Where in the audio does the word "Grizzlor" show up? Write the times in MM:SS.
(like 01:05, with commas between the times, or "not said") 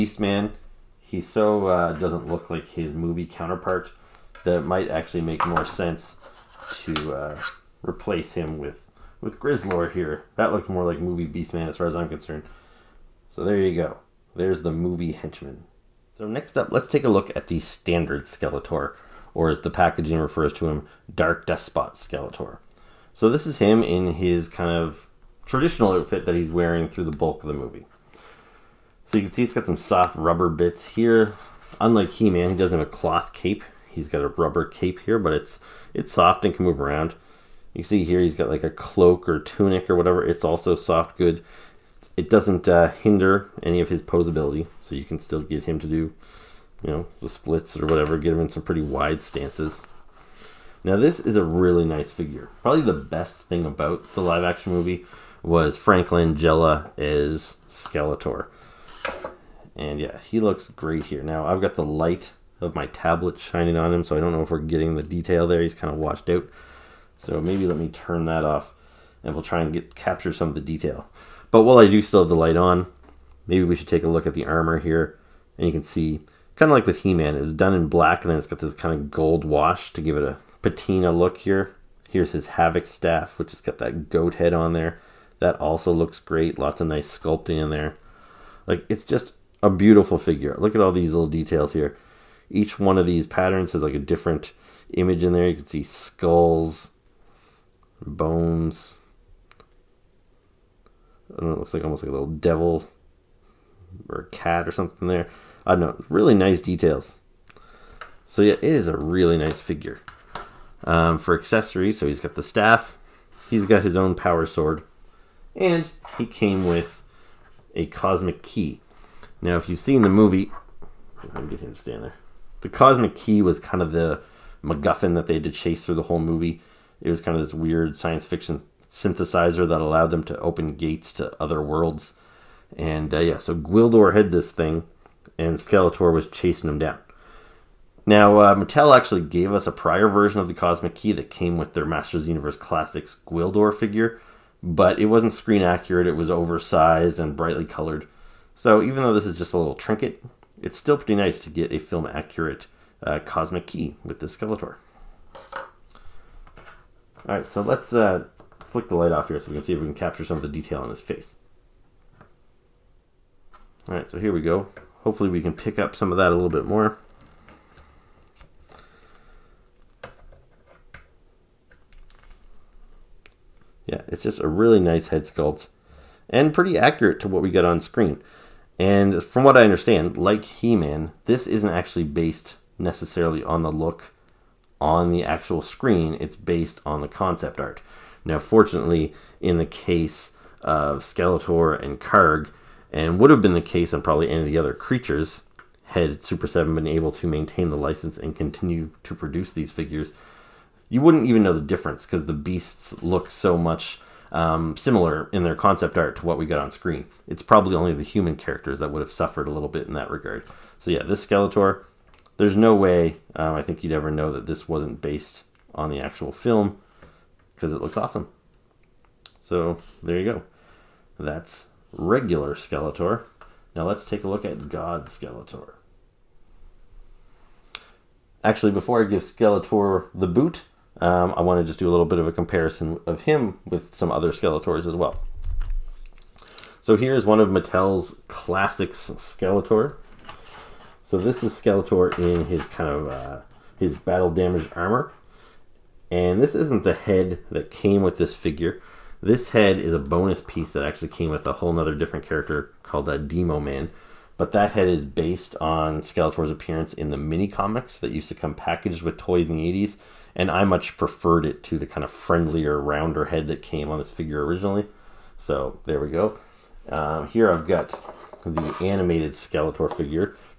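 00:09.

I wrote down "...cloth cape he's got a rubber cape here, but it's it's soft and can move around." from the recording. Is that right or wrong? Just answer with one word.
right.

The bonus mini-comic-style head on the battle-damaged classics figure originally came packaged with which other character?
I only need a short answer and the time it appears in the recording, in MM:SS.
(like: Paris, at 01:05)
Demo Man, at 04:13.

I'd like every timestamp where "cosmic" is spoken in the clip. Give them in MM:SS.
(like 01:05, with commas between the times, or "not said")
01:57, 02:02, 02:20, 02:33.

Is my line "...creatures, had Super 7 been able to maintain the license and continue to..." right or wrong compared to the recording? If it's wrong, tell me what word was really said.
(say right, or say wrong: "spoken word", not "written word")
right.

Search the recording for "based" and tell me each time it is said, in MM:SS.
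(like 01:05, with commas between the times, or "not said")
03:02, 03:06, 03:35, 04:15.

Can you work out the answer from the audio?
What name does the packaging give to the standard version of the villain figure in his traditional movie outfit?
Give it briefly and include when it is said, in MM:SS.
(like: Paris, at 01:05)
Dark Despot Skeletor, at 00:21.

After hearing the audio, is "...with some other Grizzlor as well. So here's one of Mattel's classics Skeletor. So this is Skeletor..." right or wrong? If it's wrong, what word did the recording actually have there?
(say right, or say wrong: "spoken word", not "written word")
wrong: "Skeletors", not "Grizzlor".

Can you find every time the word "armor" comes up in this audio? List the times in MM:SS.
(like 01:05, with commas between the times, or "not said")
01:14, 04:04.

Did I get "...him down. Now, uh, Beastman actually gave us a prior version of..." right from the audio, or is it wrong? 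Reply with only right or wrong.
wrong.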